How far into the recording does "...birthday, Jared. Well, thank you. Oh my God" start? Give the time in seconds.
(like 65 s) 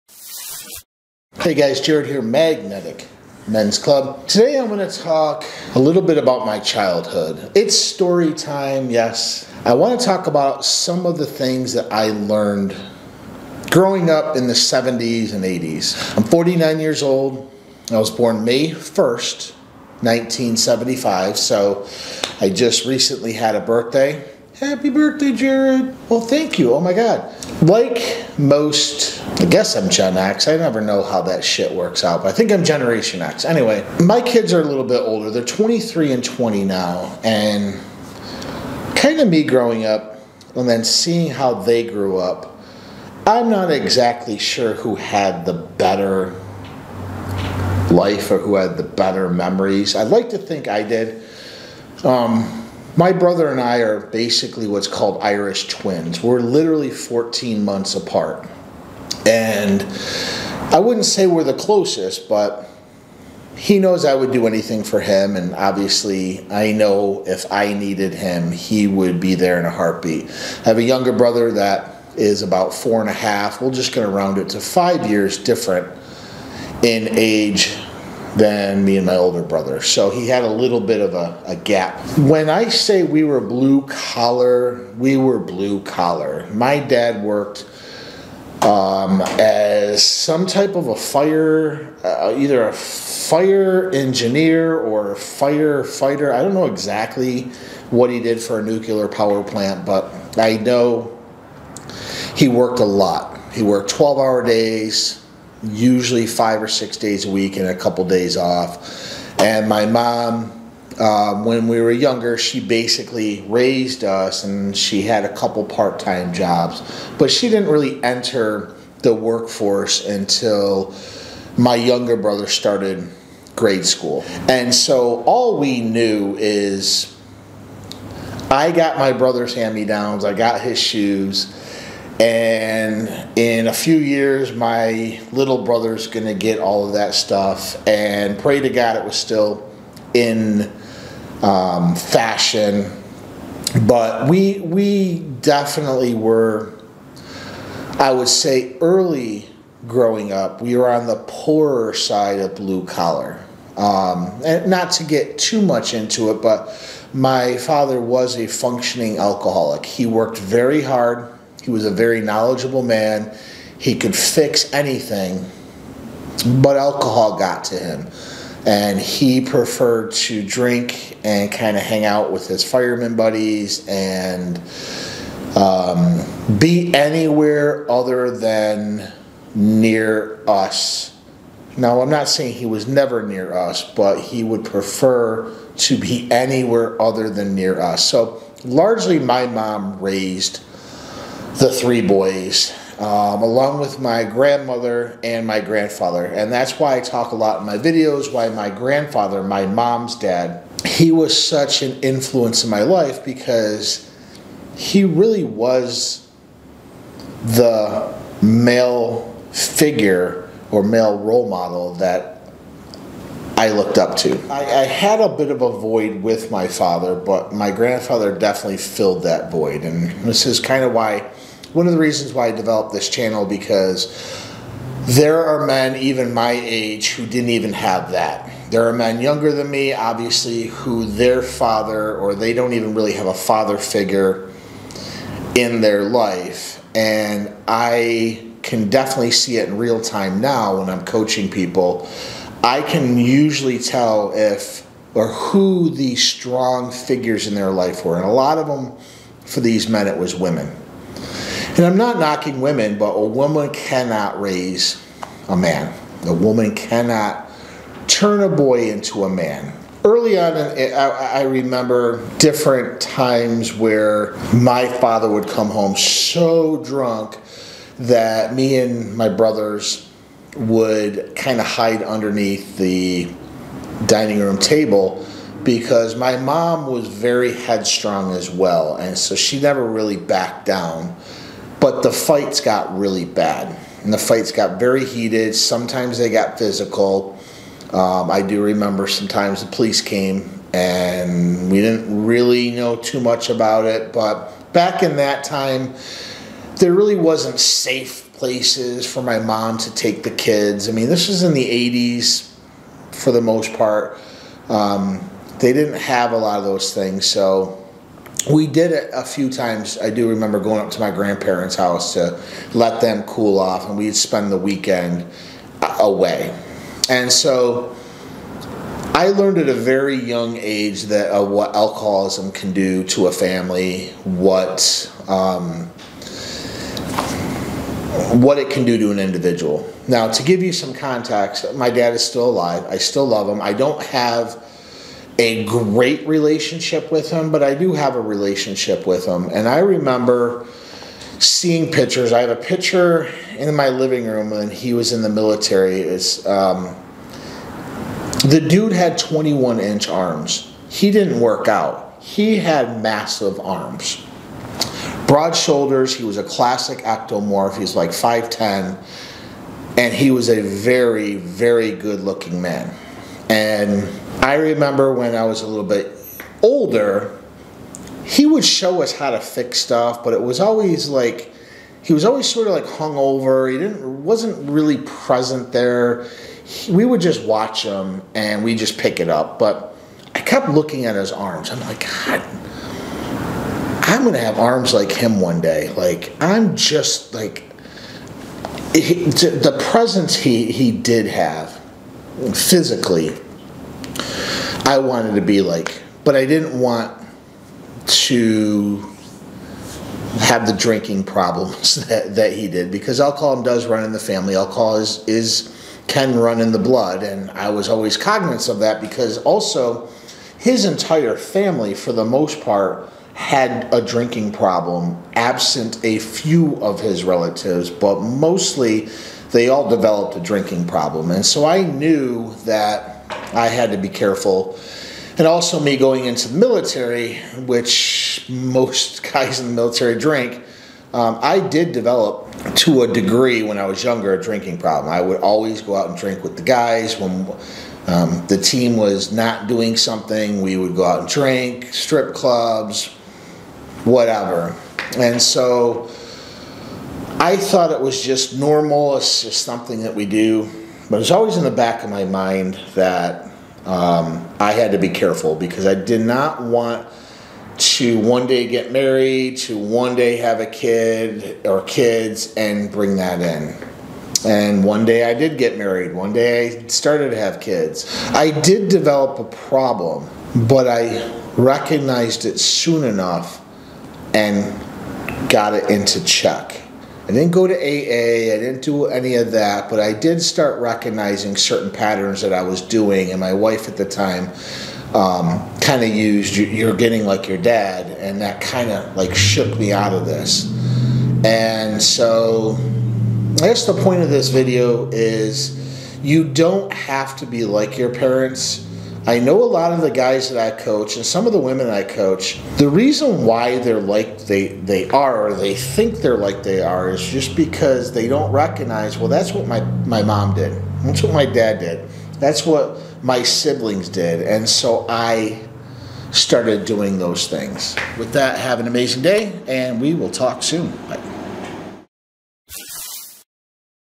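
24 s.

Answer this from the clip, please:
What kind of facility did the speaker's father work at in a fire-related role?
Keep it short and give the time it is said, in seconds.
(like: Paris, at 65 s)
nuclear power plant, at 98 s.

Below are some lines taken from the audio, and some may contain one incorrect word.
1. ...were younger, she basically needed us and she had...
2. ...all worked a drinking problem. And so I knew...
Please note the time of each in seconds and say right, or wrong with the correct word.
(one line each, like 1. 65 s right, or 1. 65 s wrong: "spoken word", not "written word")
1. 111 s wrong: "raised", not "needed"
2. 419 s wrong: "developed", not "worked".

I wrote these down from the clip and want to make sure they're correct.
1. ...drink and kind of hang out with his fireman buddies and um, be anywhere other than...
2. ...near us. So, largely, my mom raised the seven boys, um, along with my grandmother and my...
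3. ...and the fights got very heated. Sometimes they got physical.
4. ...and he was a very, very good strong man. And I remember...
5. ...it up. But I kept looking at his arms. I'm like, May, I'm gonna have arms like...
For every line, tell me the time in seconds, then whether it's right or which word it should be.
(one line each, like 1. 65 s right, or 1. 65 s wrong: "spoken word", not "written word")
1. 170 s right
2. 187 s wrong: "three", not "seven"
3. 284 s right
4. 359 s wrong: "looking", not "strong"
5. 379 s wrong: "God", not "May".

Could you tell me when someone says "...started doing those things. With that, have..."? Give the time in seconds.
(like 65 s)
516 s.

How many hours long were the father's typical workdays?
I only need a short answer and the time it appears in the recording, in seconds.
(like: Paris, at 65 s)
12, at 103 s.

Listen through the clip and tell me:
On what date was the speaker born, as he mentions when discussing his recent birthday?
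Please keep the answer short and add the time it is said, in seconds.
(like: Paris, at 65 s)
May 1st, 1975, at 18 s.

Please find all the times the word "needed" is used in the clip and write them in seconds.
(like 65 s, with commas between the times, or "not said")
67 s.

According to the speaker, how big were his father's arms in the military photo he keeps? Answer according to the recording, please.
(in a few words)
21 inch.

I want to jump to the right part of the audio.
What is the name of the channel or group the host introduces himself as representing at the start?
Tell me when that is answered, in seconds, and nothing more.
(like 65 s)
2 s.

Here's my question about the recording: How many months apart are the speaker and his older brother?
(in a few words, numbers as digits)
14.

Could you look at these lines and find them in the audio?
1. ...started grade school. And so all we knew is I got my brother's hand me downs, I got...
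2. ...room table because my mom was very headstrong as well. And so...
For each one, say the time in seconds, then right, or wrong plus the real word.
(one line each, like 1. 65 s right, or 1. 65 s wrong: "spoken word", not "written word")
1. 122 s right
2. 274 s right.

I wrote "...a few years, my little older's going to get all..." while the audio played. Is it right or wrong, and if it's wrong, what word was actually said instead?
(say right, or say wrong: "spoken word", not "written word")
wrong: "brother", not "older".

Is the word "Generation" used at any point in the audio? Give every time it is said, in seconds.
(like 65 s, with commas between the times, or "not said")
32 s.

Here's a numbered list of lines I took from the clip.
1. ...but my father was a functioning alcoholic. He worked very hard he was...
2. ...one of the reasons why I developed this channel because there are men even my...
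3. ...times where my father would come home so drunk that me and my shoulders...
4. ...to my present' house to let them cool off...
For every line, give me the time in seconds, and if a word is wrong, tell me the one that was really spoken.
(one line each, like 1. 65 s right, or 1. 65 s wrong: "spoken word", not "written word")
1. 156 s right
2. 221 s right
3. 262 s wrong: "brothers", not "shoulders"
4. 310 s wrong: "grandparents", not "present".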